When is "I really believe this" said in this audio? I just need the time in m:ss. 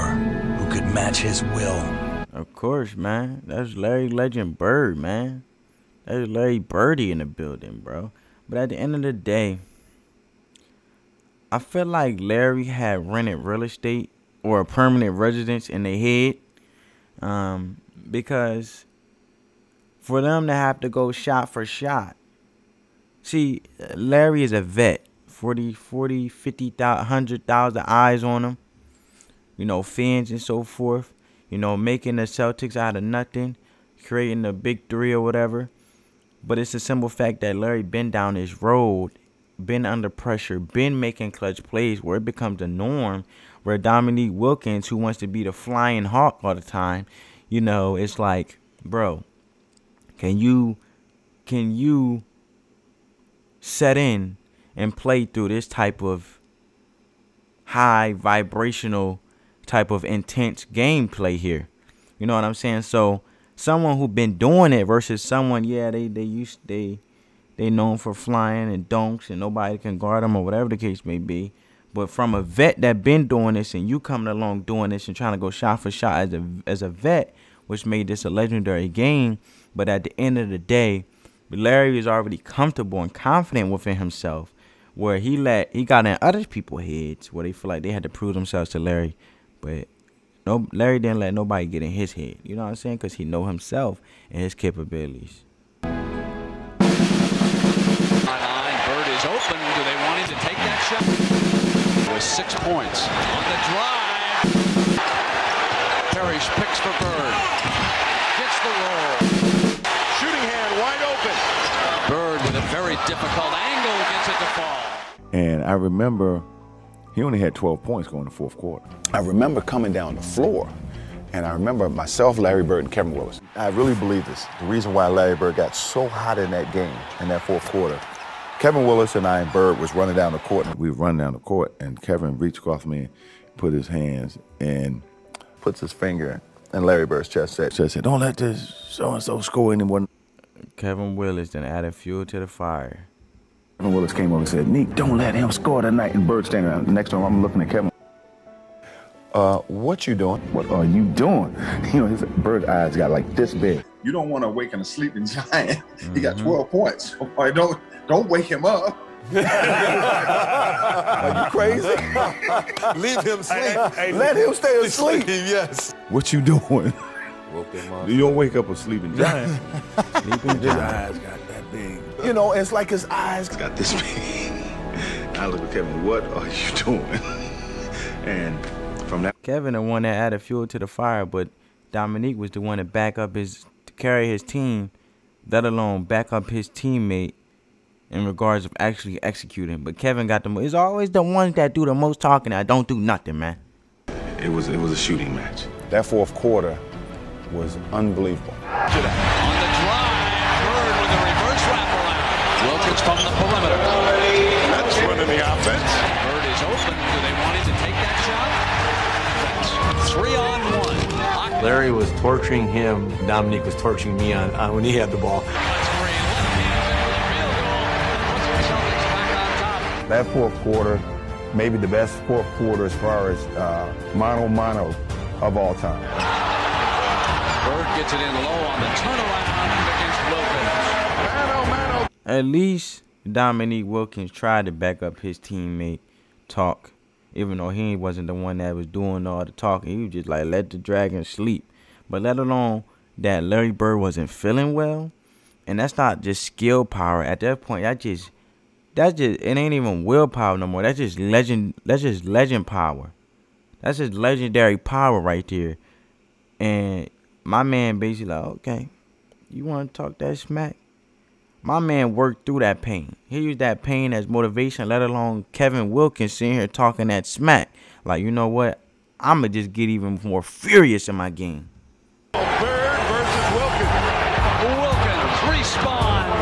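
2:03.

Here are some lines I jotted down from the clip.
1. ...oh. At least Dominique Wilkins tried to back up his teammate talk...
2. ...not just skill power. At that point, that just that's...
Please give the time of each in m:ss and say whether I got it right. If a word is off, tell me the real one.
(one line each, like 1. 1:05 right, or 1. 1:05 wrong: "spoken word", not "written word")
1. 3:52 right
2. 4:05 right.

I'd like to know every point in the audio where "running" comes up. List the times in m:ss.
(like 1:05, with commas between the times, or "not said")
2:09, 3:25.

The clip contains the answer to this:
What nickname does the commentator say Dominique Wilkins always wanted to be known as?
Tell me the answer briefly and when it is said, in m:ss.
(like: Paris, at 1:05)
the flying hawk, at 0:45.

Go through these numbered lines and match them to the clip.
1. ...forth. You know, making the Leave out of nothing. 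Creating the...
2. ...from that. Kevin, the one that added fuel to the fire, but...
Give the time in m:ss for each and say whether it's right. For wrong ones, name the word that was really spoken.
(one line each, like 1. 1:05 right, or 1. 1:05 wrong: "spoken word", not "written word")
1. 0:30 wrong: "Celtics", not "Leave"
2. 2:59 right.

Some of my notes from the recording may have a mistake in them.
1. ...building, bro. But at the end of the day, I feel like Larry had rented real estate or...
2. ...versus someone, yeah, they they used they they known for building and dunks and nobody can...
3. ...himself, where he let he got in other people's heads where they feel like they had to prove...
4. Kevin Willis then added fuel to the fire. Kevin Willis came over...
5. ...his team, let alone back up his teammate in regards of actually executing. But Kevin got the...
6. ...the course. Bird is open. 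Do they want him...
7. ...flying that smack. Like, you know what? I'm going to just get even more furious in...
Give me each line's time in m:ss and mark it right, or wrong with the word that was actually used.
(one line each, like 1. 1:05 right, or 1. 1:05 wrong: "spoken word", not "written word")
1. 0:07 right
2. 1:04 wrong: "flying", not "building"
3. 1:23 right
4. 2:20 right
5. 3:04 right
6. 3:25 wrong: "offense", not "course"
7. 4:26 wrong: "talking", not "flying".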